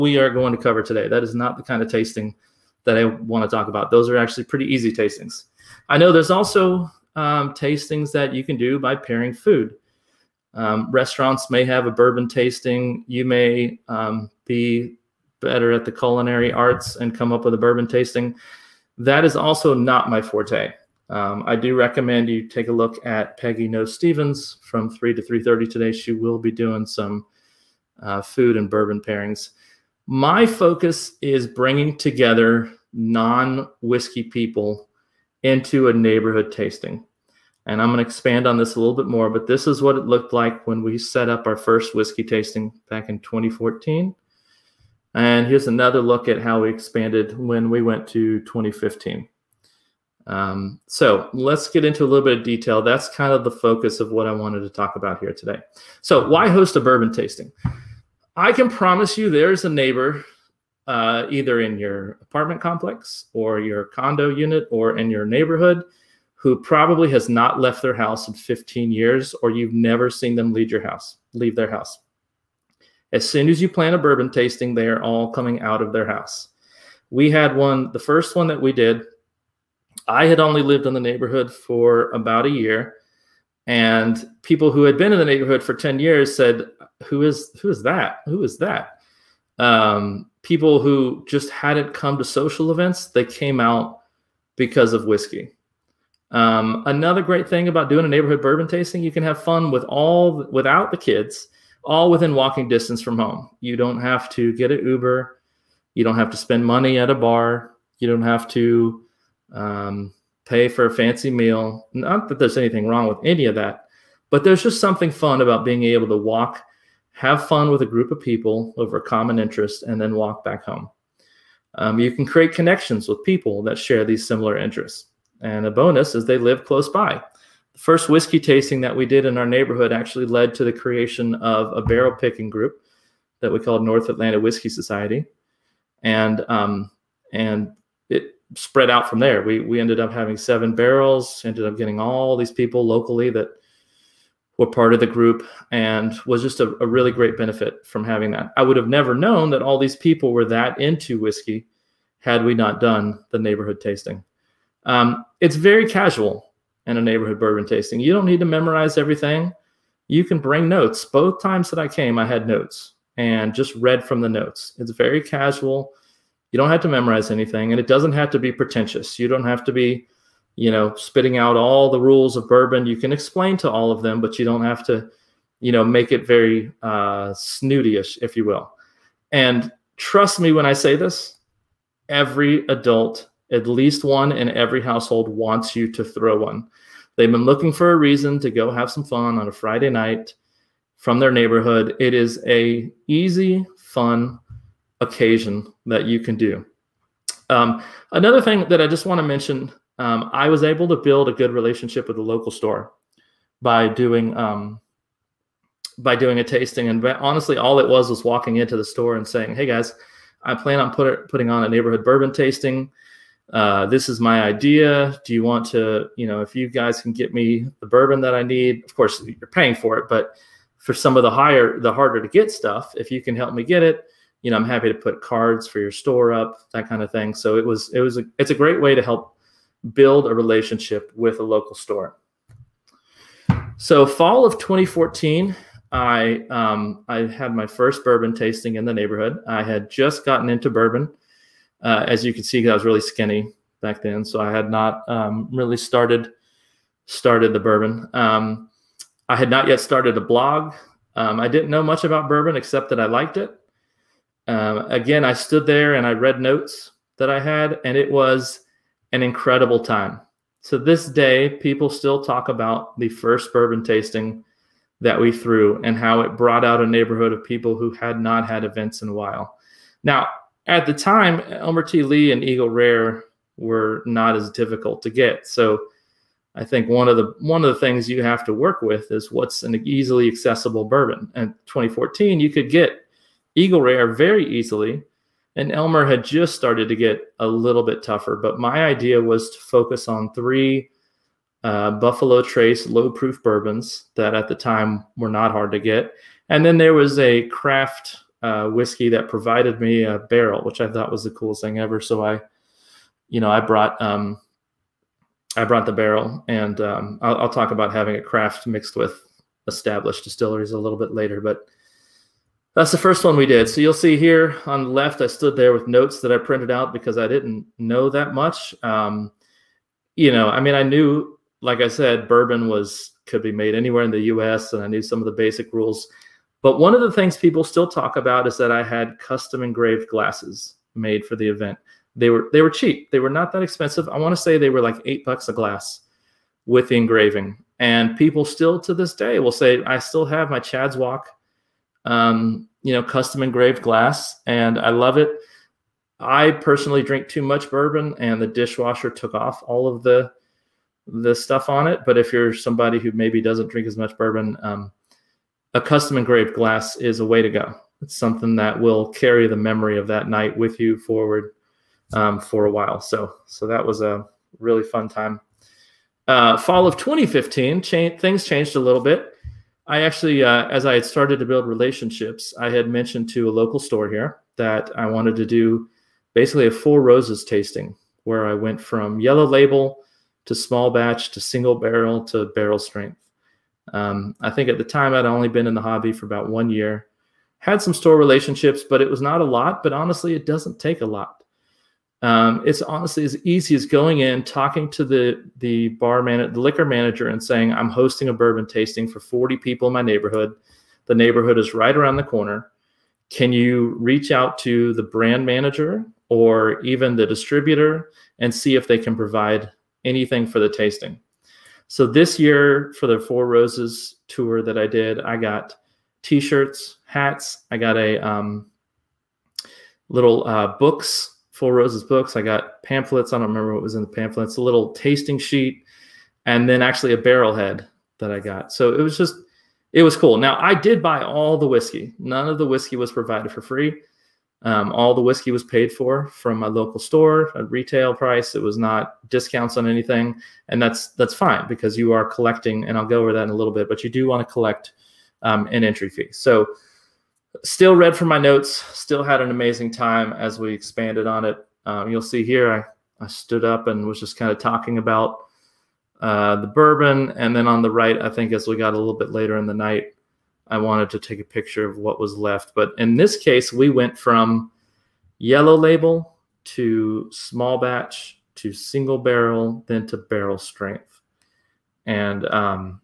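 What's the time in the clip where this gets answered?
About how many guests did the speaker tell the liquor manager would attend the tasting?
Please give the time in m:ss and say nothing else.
6:39.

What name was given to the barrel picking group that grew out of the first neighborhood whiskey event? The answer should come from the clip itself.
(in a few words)
North Atlanta Whiskey Society.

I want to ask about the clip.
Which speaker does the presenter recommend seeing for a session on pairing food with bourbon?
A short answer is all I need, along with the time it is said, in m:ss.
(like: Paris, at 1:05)
Peggy Noe Stevens, at 0:23.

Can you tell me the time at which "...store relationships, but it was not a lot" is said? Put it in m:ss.
6:27.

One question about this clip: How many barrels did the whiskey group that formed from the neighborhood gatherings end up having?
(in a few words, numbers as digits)
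7.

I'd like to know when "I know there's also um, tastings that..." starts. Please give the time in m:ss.
0:05.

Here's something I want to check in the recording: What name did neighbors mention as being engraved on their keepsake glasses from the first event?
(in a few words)
Chad's Walk.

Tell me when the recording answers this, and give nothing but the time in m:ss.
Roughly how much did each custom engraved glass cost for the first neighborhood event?
5:35.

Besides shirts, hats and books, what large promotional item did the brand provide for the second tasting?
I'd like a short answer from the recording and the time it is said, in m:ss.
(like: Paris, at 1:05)
A barrel head, at 7:07.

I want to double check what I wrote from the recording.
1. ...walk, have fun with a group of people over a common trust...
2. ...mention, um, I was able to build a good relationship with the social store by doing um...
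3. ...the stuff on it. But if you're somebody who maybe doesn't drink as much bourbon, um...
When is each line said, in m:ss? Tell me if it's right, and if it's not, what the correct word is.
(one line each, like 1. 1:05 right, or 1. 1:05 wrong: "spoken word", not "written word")
1. 1:56 wrong: "interest", not "trust"
2. 3:19 wrong: "local", not "social"
3. 5:51 right.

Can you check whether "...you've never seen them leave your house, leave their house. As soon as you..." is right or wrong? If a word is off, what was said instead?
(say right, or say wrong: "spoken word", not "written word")
right.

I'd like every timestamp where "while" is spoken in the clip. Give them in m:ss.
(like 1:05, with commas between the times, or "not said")
4:29, 6:02.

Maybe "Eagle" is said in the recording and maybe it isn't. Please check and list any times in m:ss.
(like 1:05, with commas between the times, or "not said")
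4:32, 4:43.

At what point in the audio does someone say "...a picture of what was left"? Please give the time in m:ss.
7:41.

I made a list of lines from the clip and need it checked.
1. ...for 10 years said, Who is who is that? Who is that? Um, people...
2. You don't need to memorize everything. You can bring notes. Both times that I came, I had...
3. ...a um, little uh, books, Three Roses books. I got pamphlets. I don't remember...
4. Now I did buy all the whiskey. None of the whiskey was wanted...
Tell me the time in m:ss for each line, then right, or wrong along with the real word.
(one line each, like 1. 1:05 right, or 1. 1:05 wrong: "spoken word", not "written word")
1. 1:25 right
2. 2:37 right
3. 6:57 wrong: "Four", not "Three"
4. 7:10 wrong: "provided", not "wanted".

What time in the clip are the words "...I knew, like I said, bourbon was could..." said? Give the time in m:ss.
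5:20.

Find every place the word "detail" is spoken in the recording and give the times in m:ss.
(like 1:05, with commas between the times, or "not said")
0:52.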